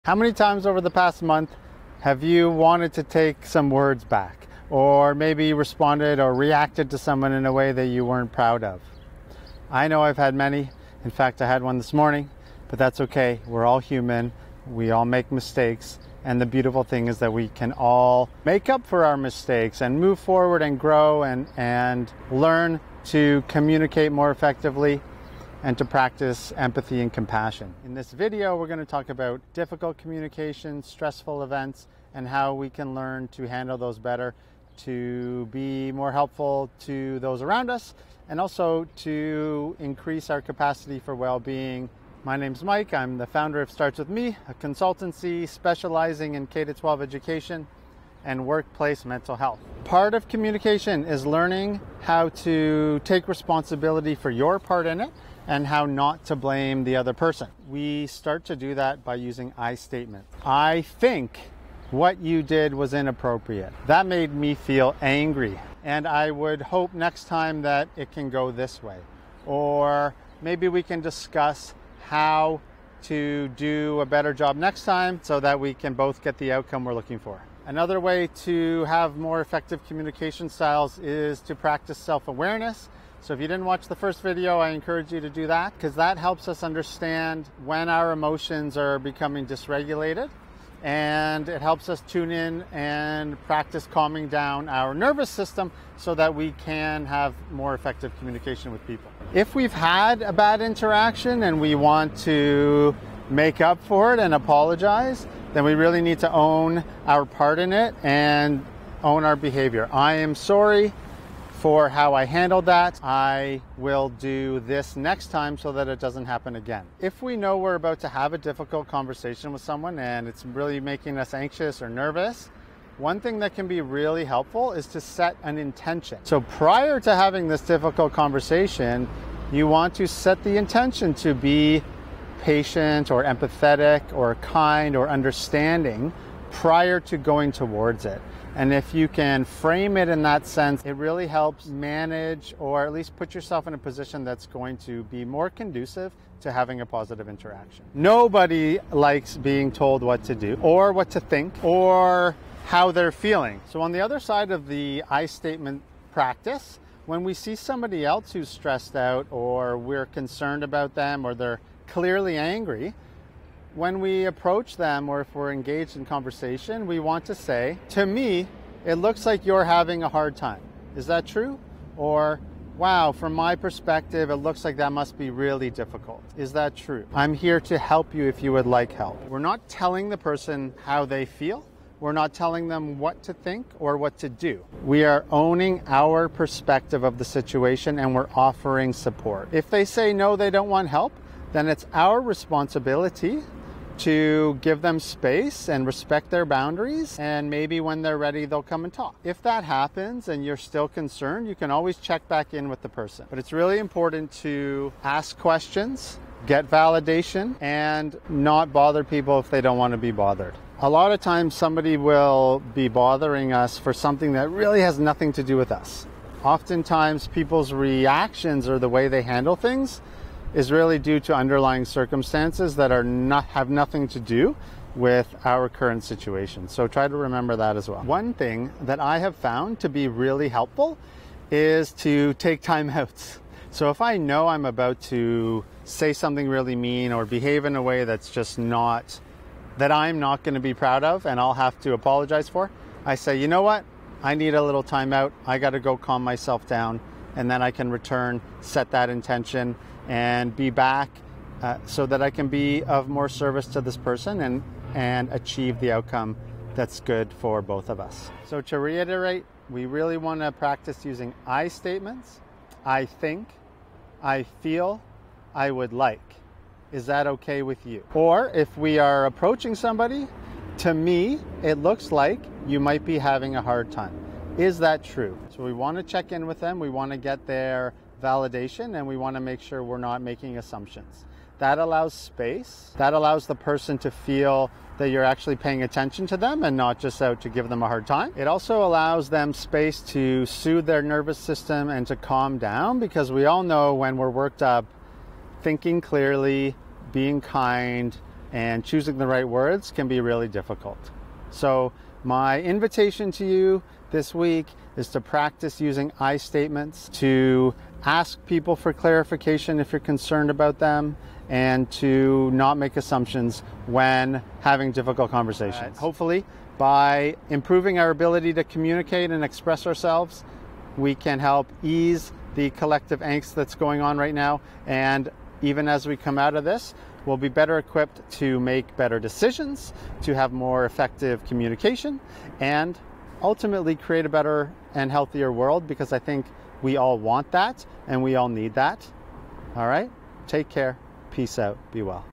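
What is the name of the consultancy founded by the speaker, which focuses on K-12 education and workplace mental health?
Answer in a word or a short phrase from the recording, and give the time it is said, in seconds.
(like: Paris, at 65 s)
Starts With Me, at 43 s.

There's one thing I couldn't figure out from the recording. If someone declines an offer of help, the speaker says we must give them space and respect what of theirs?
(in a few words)
their boundaries.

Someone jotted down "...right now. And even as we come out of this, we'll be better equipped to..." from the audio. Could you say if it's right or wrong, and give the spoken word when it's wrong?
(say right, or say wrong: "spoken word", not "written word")
right.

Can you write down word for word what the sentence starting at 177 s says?
I'm here to help you if you would like help.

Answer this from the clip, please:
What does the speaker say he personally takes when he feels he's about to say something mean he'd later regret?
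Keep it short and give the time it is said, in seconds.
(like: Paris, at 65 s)
timeouts, at 232 s.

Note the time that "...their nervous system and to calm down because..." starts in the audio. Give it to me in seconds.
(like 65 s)
290 s.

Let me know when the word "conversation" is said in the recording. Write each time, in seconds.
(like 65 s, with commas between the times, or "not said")
118 s, 128 s, 166 s, 315 s.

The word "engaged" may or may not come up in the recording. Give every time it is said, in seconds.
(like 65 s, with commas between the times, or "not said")
165 s.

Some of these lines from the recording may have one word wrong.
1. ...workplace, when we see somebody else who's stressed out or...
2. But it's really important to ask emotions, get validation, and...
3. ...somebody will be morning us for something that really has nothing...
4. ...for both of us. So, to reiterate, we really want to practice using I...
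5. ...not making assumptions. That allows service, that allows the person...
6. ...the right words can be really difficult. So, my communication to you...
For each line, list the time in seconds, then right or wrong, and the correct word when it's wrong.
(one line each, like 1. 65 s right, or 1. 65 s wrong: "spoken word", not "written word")
1. 156 s wrong: "practice", not "workplace"
2. 203 s wrong: "questions", not "emotions"
3. 211 s wrong: "bothering", not "morning"
4. 257 s right
5. 279 s wrong: "space", not "service"
6. 299 s wrong: "invitation", not "communication".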